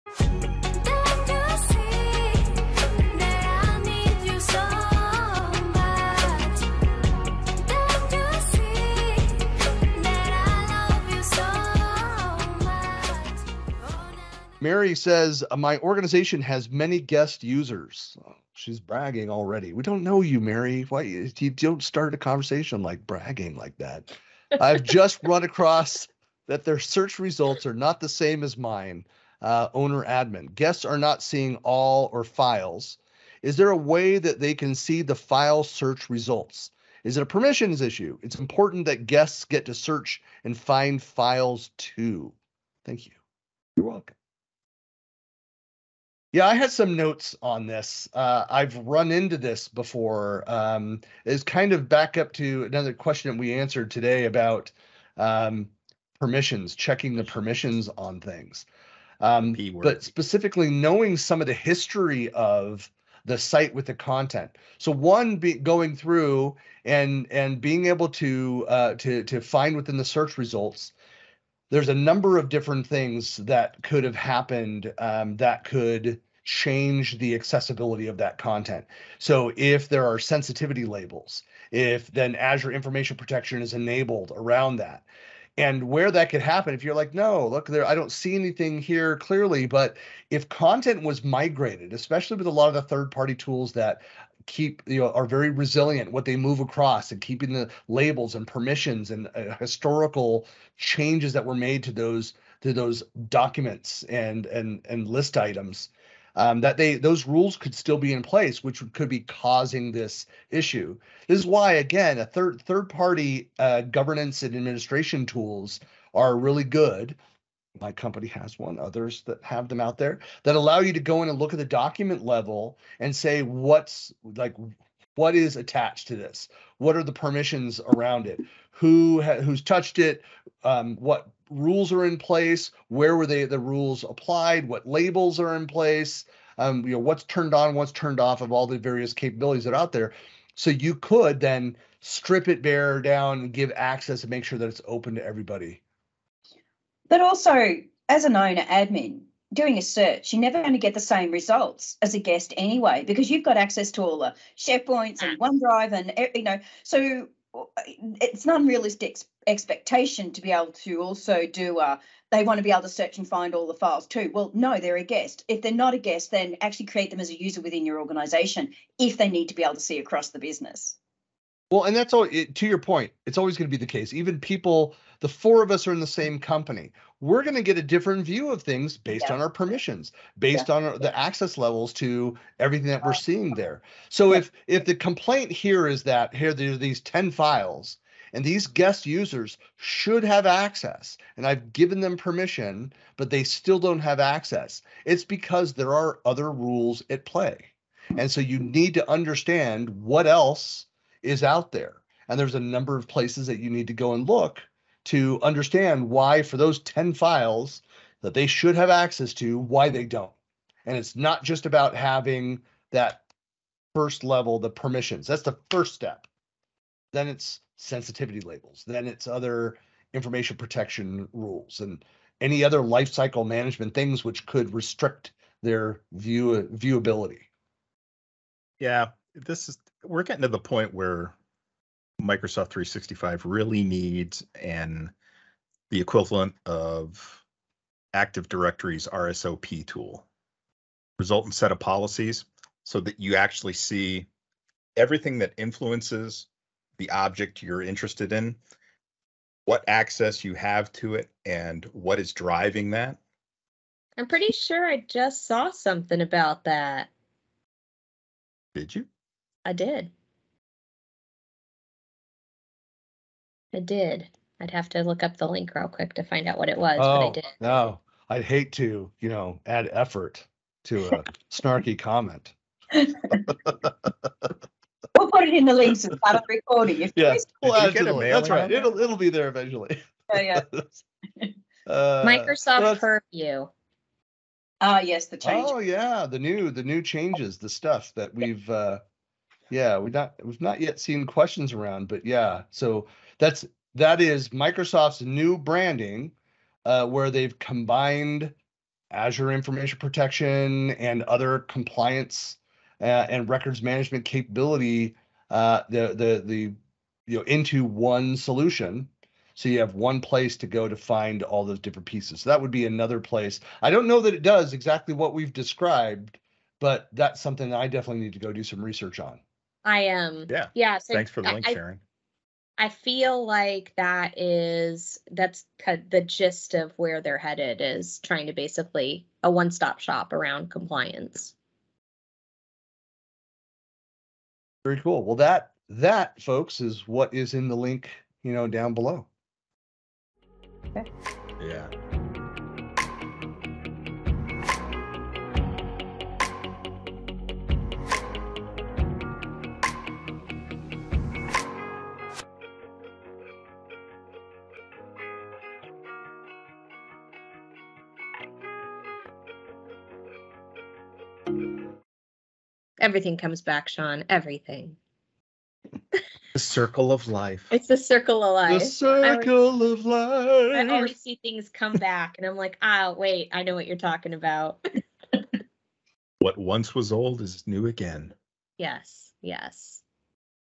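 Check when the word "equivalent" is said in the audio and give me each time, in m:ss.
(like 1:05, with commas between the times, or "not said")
3:55.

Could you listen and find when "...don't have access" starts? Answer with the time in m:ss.
3:13.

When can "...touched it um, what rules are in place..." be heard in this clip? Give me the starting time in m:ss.
2:09.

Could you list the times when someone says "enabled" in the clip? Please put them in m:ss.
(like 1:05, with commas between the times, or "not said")
1:23.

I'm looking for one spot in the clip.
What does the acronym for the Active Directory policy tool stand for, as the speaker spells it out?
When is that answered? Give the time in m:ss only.
4:01.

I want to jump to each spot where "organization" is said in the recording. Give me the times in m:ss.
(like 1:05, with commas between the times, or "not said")
0:15, 2:47.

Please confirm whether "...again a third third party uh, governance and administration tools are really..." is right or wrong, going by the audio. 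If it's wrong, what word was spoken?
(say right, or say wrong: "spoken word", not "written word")
right.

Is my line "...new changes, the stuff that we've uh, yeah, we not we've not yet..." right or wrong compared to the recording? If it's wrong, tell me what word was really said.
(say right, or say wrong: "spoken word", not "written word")
right.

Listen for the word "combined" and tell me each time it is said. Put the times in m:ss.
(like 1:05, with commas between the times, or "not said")
4:57.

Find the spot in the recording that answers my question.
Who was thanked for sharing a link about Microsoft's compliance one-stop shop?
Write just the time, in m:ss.
5:21.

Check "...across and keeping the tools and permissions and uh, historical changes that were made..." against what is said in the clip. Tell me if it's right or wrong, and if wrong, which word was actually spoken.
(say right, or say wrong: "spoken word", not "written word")
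wrong: "labels", not "tools".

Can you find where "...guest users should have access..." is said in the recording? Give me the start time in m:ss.
3:08.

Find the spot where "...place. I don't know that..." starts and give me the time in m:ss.
5:13.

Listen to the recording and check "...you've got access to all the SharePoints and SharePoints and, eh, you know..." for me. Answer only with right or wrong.
wrong.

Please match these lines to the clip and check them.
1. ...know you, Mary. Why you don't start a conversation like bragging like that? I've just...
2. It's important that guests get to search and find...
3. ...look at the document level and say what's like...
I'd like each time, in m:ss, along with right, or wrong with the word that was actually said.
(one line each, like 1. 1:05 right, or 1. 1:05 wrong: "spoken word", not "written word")
1. 0:20 right
2. 0:38 right
3. 2:01 right.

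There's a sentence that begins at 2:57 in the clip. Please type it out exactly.
We're going to get a different view of things based yeah.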